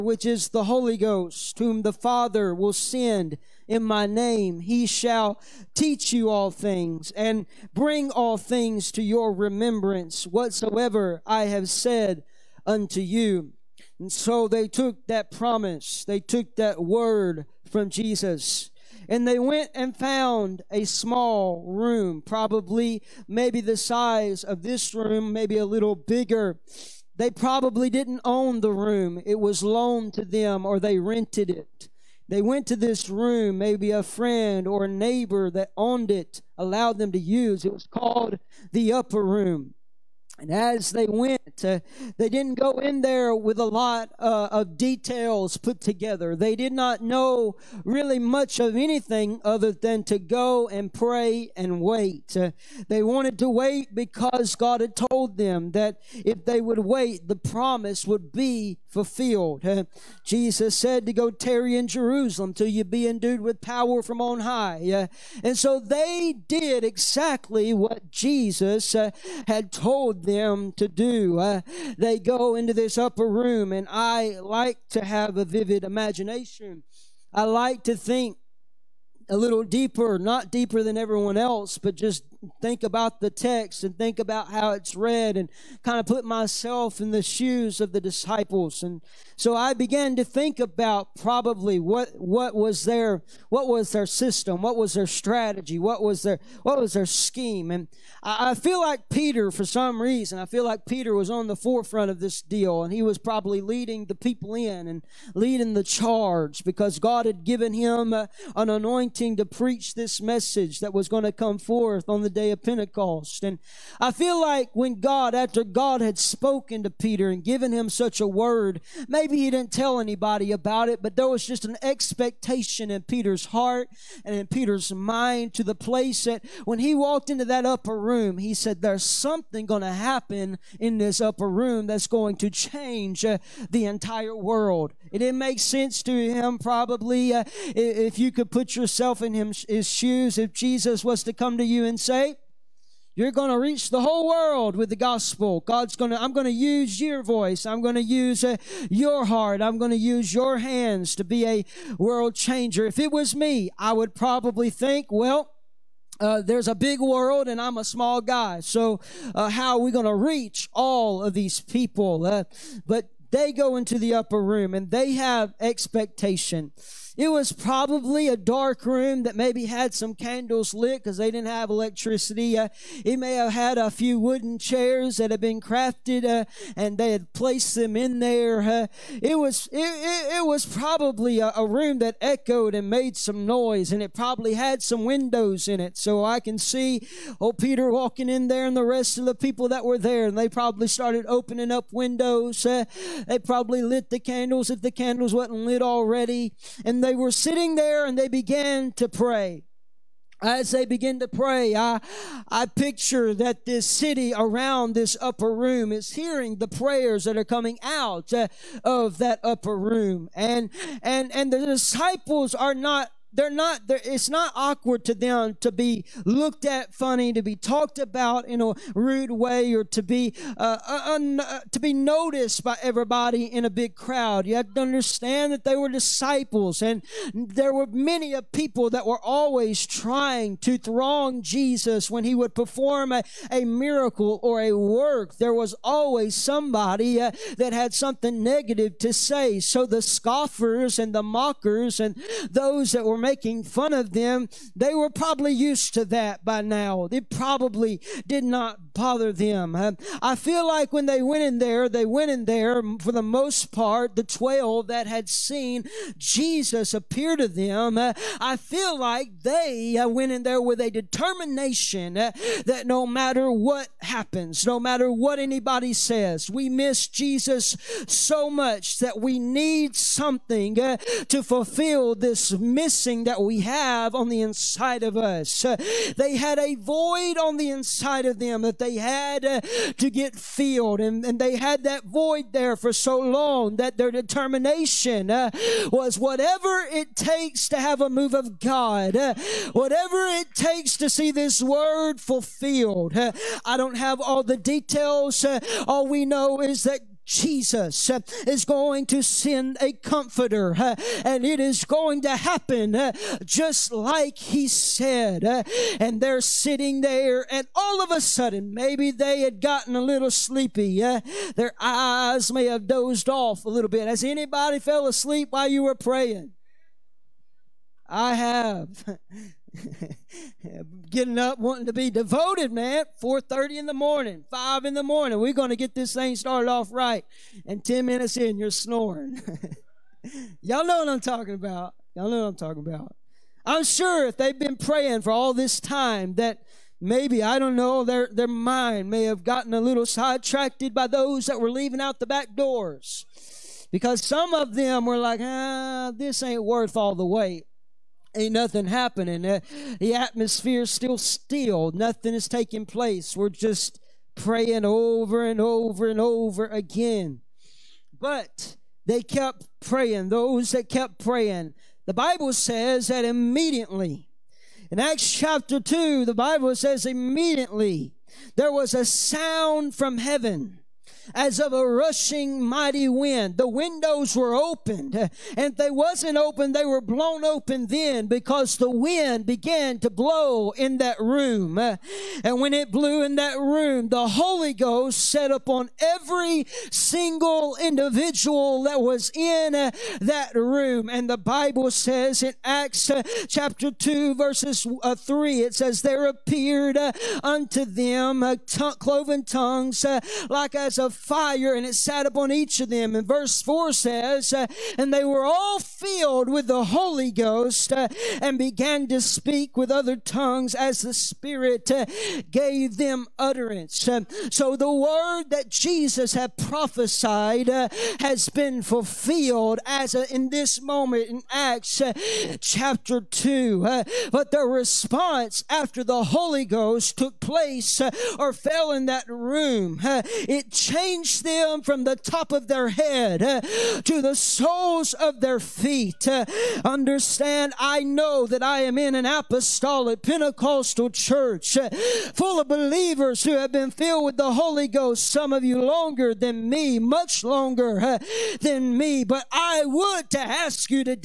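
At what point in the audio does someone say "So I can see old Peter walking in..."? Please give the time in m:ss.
3:05.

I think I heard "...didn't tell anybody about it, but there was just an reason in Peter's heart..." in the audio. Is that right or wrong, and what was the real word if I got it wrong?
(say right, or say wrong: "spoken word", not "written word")
wrong: "expectation", not "reason".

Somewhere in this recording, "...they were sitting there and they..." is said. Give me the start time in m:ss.
3:17.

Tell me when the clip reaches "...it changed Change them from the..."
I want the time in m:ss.
7:10.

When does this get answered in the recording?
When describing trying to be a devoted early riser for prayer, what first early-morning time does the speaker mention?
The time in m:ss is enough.
5:23.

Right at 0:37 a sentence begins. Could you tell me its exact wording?
It was called the upper room.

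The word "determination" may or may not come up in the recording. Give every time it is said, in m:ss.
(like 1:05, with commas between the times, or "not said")
4:20, 4:44.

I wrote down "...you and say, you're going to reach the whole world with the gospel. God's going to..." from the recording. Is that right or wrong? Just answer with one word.
right.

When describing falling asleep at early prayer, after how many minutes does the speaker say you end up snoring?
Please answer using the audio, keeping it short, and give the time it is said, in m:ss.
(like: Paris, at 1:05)
10, at 5:27.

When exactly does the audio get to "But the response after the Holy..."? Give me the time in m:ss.
7:04.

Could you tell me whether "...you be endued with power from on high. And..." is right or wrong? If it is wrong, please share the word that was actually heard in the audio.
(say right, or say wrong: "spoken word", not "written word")
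right.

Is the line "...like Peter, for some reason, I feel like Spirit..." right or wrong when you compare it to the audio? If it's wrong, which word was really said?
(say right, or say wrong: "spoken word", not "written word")
wrong: "Peter", not "Spirit".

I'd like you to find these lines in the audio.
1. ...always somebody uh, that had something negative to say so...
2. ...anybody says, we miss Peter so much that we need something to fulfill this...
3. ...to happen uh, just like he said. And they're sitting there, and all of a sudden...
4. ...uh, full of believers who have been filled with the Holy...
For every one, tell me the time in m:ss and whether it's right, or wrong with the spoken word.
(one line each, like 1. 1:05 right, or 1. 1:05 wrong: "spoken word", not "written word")
1. 3:55 right
2. 4:25 wrong: "Jesus", not "Peter"
3. 5:02 right
4. 7:21 right.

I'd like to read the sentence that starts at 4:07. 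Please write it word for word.
It probably did not bother them.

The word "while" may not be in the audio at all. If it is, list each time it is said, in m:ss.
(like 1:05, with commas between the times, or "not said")
5:15.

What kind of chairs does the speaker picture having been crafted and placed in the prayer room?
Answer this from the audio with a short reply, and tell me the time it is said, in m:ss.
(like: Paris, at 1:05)
wooden chairs, at 2:54.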